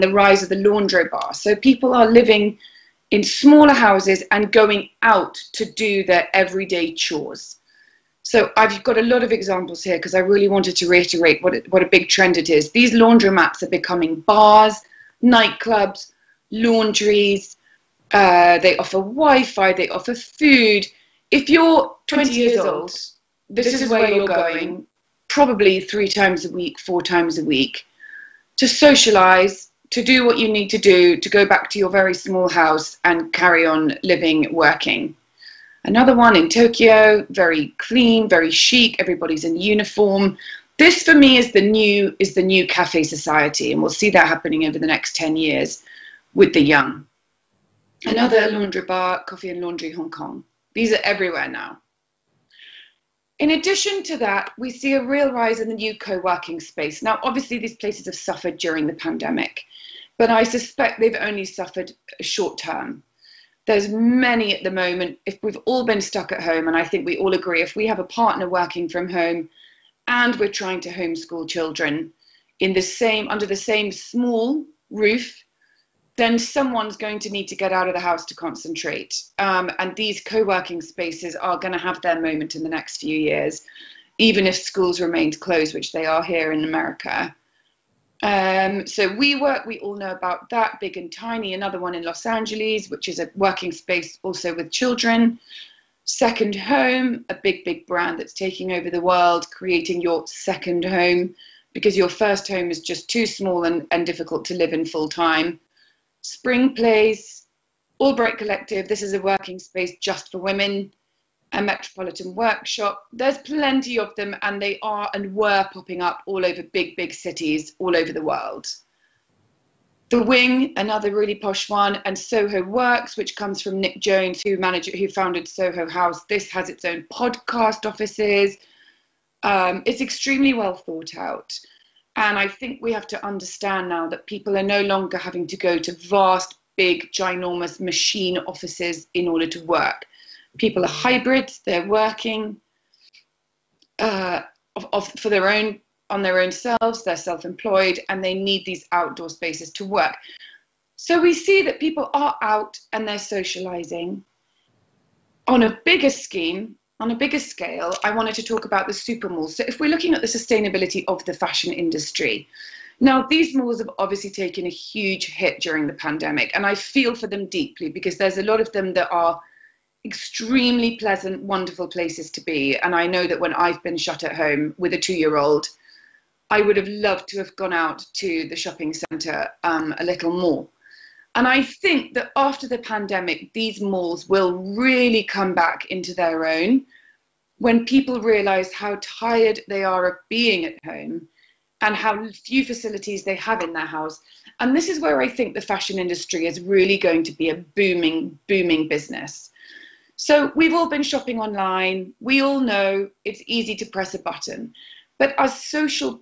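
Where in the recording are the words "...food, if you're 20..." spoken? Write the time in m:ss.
0:20.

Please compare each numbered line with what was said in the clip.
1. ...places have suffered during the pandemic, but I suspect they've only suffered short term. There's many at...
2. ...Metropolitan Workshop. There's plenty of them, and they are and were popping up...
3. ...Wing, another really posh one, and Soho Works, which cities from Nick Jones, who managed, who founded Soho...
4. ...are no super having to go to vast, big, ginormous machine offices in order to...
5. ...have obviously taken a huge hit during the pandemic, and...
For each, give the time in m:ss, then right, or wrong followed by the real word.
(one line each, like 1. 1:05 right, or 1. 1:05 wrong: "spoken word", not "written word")
1. 0:57 right
2. 1:51 right
3. 2:00 wrong: "comes", not "cities"
4. 2:14 wrong: "longer", not "super"
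5. 2:43 right.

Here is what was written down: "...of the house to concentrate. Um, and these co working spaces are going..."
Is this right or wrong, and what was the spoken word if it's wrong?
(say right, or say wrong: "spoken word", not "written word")
right.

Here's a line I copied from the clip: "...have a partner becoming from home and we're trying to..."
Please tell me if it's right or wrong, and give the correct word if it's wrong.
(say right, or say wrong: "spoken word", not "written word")
wrong: "working", not "becoming".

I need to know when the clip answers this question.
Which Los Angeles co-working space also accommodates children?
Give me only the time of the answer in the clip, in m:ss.
1:30.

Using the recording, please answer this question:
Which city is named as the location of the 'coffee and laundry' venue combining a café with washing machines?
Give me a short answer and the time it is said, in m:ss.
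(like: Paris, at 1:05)
Hong Kong, at 0:49.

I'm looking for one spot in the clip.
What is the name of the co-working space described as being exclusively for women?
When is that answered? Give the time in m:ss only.
1:48.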